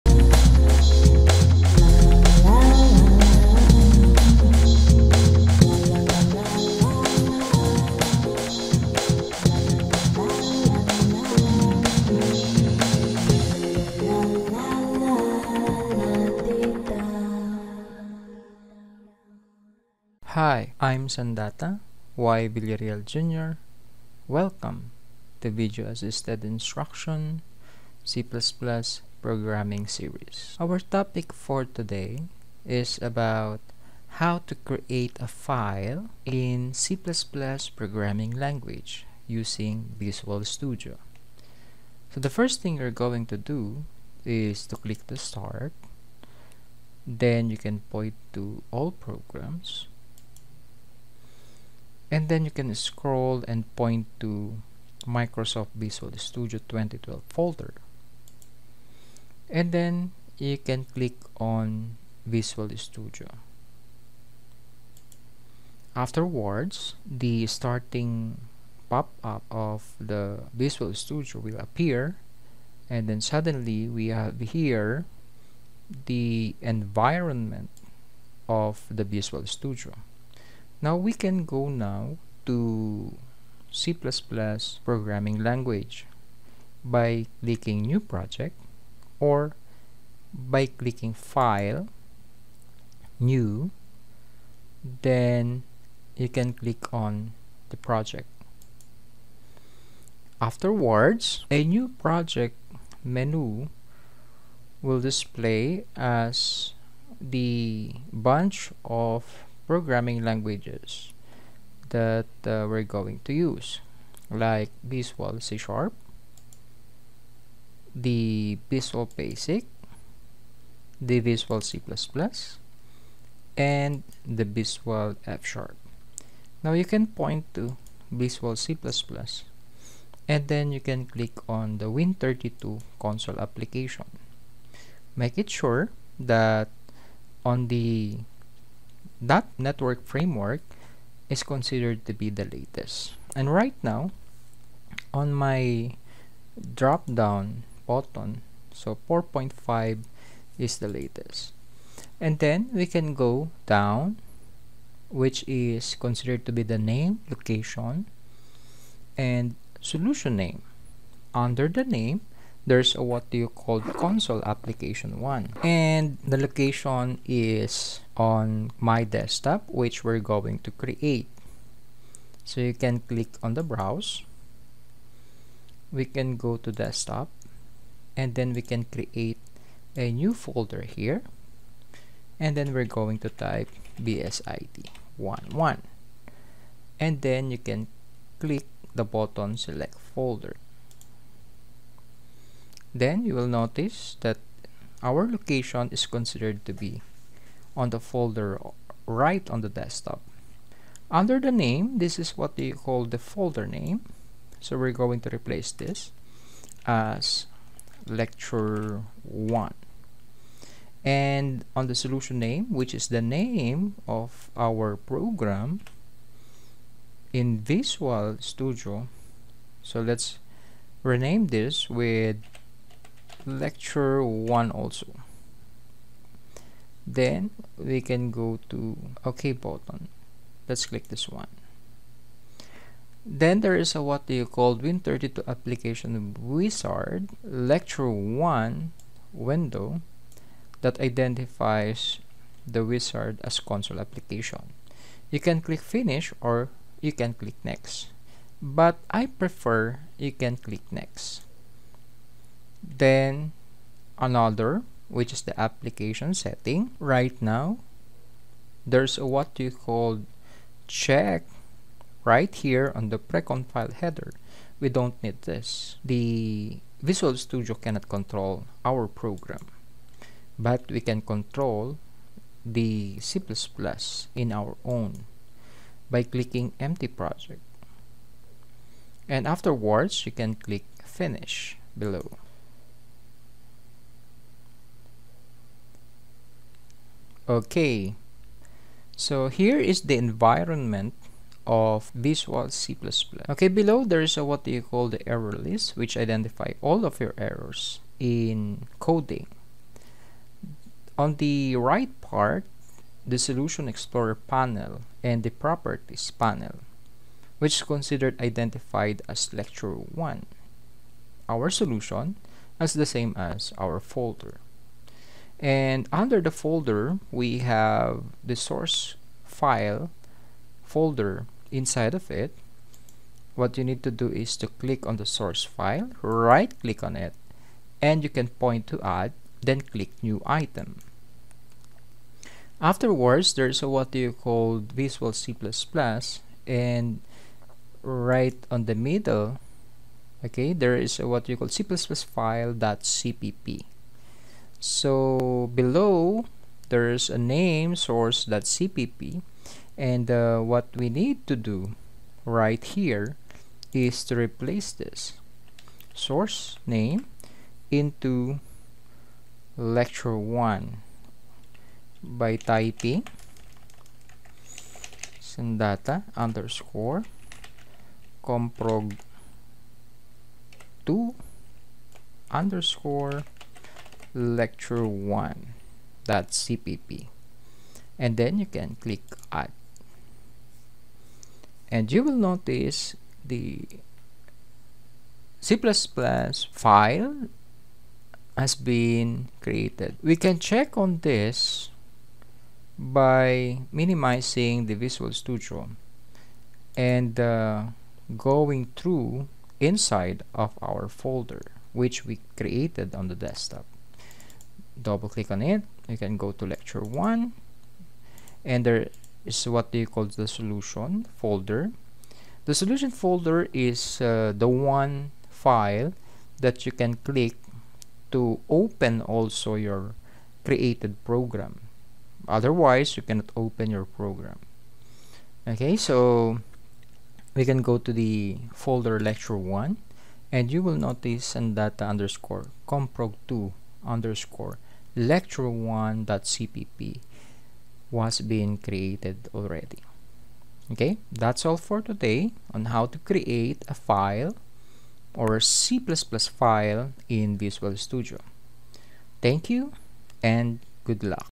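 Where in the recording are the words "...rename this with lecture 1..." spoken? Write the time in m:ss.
3:41.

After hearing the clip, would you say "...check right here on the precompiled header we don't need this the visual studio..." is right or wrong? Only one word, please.
right.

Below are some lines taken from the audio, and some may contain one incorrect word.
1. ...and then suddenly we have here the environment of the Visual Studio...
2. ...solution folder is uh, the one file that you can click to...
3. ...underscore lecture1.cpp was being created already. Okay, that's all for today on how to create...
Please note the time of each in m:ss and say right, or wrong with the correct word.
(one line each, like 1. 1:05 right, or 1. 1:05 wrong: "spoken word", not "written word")
1. 1:12 right
2. 6:52 right
3. 7:14 right.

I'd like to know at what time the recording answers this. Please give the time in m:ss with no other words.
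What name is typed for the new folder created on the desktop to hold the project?
3:03.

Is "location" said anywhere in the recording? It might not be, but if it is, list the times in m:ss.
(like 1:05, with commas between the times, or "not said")
2:37, 2:46, 3:15.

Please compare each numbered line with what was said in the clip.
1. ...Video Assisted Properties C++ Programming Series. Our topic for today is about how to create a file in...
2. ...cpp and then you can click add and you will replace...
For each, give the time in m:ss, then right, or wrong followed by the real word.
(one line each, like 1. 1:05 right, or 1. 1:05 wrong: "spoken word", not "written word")
1. 0:25 wrong: "Instruction", not "Properties"
2. 6:16 wrong: "notice", not "replace".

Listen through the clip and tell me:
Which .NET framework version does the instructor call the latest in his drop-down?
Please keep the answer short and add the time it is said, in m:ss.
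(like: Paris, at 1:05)
4.5, at 2:29.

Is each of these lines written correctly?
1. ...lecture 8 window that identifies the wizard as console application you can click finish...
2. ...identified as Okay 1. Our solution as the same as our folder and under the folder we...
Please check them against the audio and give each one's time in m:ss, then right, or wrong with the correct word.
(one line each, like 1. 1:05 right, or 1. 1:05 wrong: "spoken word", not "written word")
1. 3:57 wrong: "1", not "8"
2. 5:08 wrong: "Lecture", not "Okay".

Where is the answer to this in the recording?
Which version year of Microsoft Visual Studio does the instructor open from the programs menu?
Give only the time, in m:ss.
0:56.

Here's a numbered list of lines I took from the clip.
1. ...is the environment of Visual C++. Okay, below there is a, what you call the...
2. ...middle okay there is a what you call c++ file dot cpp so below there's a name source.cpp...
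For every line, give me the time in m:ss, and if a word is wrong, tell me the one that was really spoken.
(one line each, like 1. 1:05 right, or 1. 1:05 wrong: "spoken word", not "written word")
1. 4:49 right
2. 5:38 right.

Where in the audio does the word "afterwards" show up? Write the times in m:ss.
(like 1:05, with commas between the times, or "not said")
1:05, 1:40, 4:39, 5:32.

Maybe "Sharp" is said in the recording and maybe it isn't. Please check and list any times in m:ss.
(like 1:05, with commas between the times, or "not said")
1:55, 2:05.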